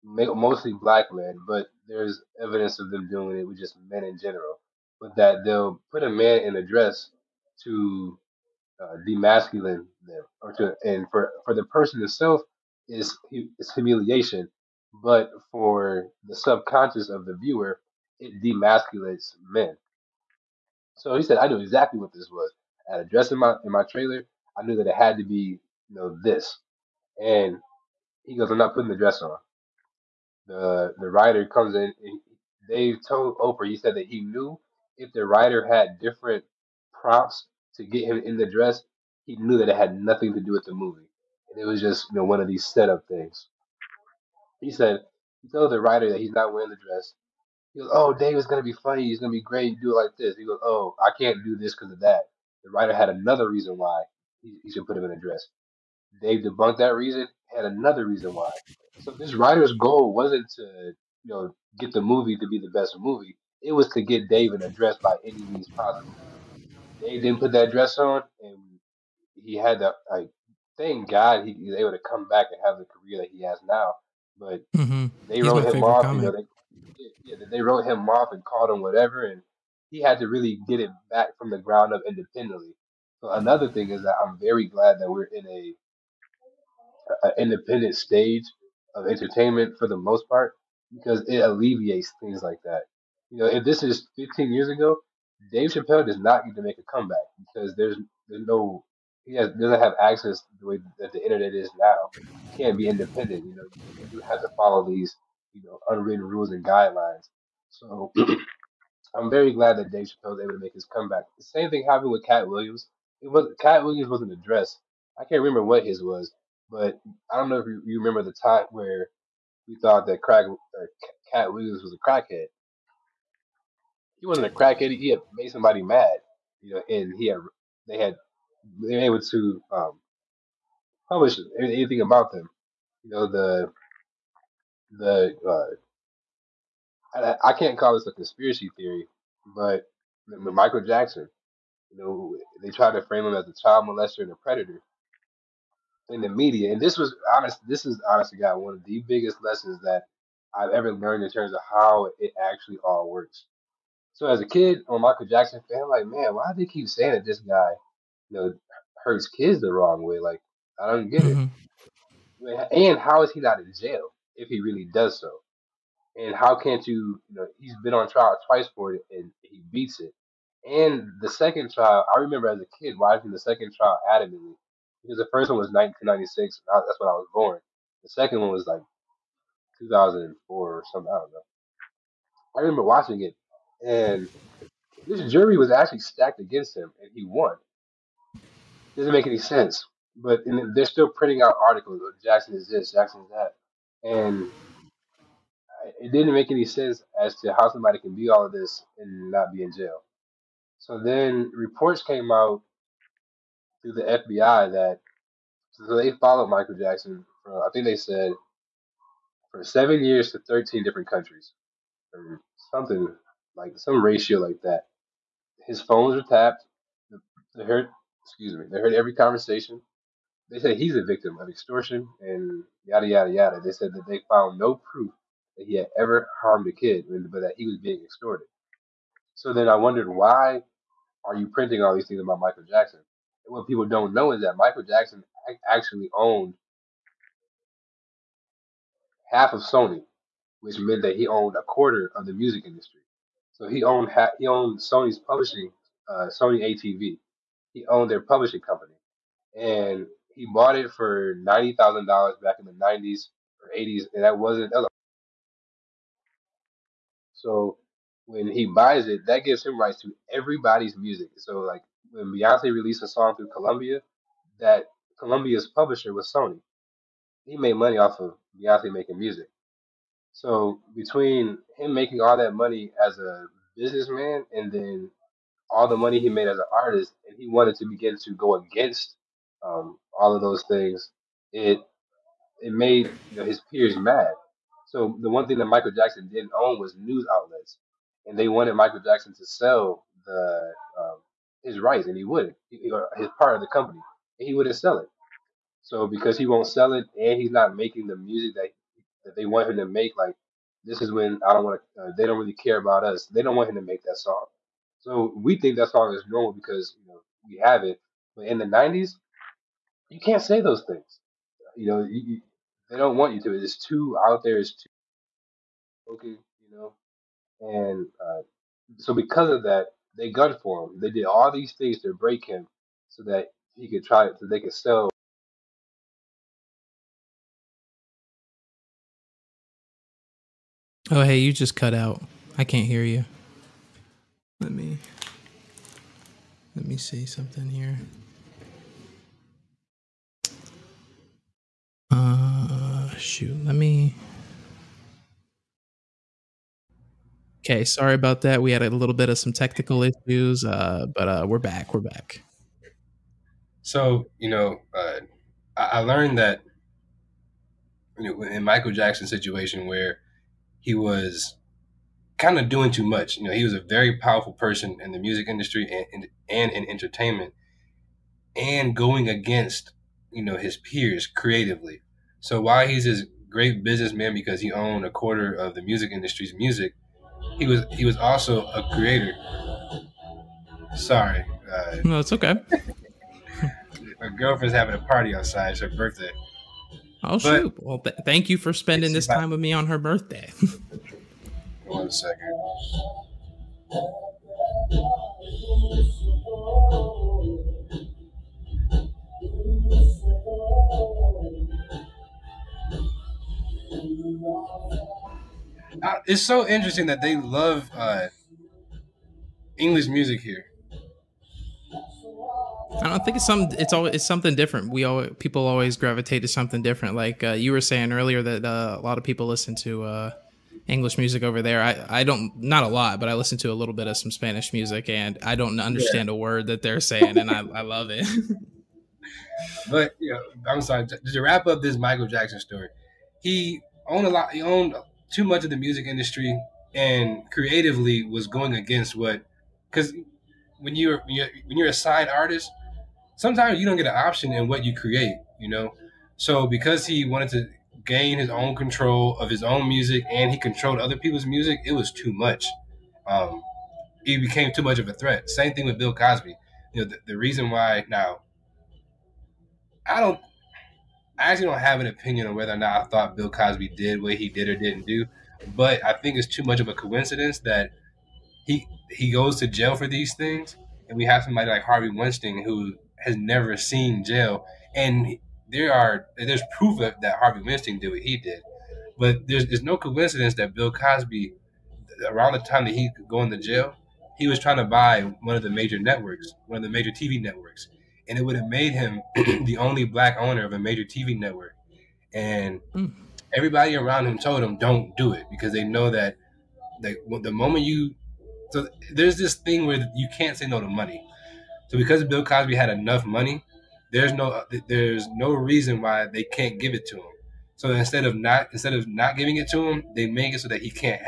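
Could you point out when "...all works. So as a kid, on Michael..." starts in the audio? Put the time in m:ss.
2:32.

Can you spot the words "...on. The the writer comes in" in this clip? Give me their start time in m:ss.
0:29.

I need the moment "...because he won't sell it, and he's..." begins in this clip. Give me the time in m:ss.
4:56.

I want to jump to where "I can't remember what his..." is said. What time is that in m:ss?
1:55.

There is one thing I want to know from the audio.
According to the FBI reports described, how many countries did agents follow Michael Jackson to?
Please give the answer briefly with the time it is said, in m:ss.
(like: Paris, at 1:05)
13, at 3:30.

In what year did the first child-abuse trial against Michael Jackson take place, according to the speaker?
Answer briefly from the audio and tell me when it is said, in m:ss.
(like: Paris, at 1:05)
1996, at 2:55.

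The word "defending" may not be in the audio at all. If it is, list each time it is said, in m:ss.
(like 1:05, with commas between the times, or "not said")
not said.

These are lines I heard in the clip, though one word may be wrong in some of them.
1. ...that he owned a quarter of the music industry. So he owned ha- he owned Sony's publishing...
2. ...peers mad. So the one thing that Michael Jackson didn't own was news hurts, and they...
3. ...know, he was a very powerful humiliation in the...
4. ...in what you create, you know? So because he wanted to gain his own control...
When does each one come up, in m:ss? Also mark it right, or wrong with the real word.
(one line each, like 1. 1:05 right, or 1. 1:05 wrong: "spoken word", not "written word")
1. 4:01 right
2. 4:43 wrong: "outlets", not "hurts"
3. 6:03 wrong: "person", not "humiliation"
4. 7:24 right.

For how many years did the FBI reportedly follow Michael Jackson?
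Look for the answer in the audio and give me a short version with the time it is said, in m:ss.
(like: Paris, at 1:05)
7, at 3:29.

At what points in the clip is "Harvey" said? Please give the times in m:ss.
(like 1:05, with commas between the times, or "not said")
7:51, 7:57.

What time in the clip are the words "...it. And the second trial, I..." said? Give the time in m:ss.
2:49.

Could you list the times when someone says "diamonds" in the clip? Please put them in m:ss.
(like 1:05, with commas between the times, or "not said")
not said.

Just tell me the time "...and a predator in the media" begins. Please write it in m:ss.
2:24.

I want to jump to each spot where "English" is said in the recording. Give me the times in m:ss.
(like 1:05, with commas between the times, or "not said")
6:49, 7:00.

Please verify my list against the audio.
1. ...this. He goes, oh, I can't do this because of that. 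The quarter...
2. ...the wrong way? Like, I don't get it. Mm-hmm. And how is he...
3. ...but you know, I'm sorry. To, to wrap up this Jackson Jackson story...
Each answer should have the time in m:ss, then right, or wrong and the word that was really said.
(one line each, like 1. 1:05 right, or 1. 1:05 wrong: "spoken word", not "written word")
1. 0:50 wrong: "writer", not "quarter"
2. 2:39 right
3. 7:09 wrong: "Michael", not "Jackson".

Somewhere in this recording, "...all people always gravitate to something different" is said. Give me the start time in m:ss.
6:55.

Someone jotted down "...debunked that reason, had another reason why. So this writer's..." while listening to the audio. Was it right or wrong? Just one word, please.
right.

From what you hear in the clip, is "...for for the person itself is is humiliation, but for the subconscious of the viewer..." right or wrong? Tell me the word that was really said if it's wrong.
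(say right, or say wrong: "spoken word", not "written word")
right.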